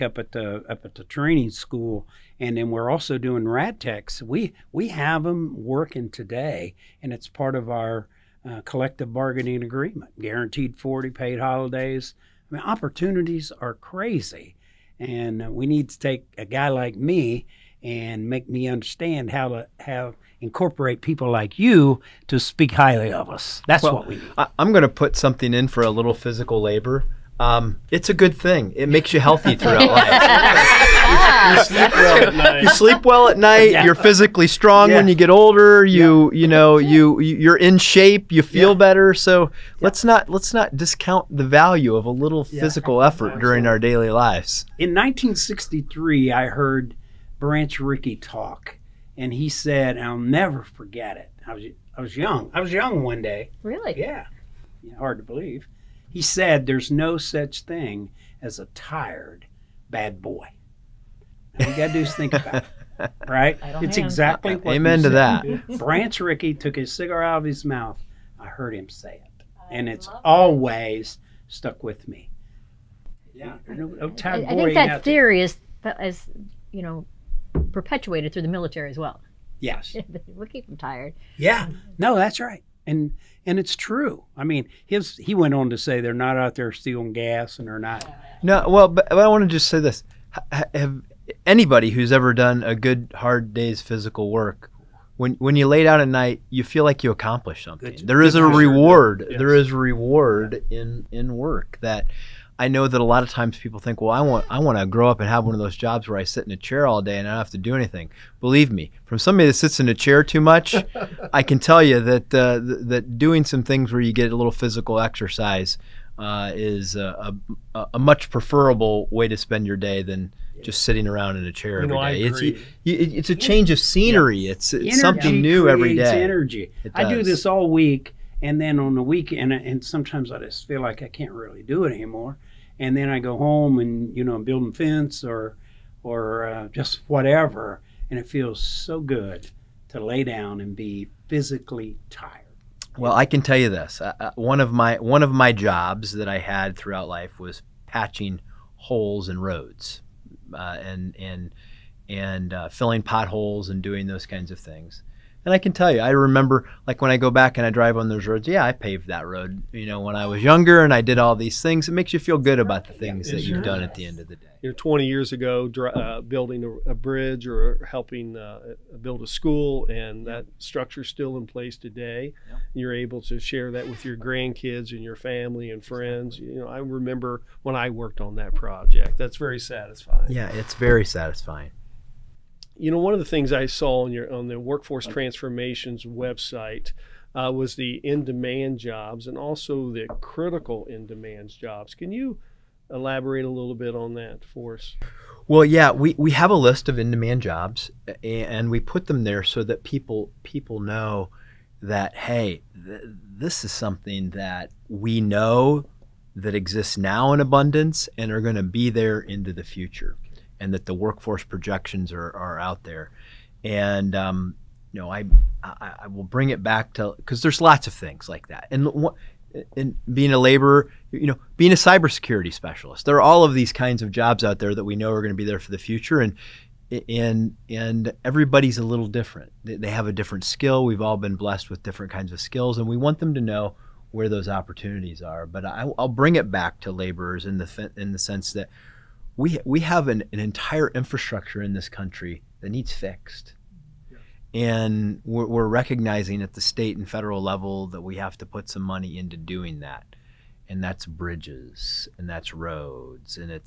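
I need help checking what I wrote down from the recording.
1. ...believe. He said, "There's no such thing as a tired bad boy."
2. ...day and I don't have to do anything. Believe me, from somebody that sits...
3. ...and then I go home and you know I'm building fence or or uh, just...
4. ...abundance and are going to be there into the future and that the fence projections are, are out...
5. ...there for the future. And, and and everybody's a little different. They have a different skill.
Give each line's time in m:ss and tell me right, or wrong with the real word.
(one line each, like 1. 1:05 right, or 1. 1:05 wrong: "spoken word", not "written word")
1. 0:55 right
2. 1:47 right
3. 2:12 right
4. 3:27 wrong: "workforce", not "fence"
5. 3:45 right.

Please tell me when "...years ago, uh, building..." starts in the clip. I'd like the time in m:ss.
2:45.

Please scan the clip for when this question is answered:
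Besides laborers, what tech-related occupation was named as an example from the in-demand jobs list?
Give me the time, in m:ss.
3:41.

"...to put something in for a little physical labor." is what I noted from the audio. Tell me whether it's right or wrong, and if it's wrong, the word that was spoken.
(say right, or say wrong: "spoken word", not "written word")
right.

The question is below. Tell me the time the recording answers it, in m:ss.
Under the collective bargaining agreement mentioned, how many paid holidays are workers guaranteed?
0:10.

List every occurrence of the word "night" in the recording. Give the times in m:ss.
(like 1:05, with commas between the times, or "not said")
0:33, 1:36.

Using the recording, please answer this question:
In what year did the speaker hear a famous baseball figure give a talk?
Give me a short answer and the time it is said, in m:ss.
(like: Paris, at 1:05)
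1963, at 0:44.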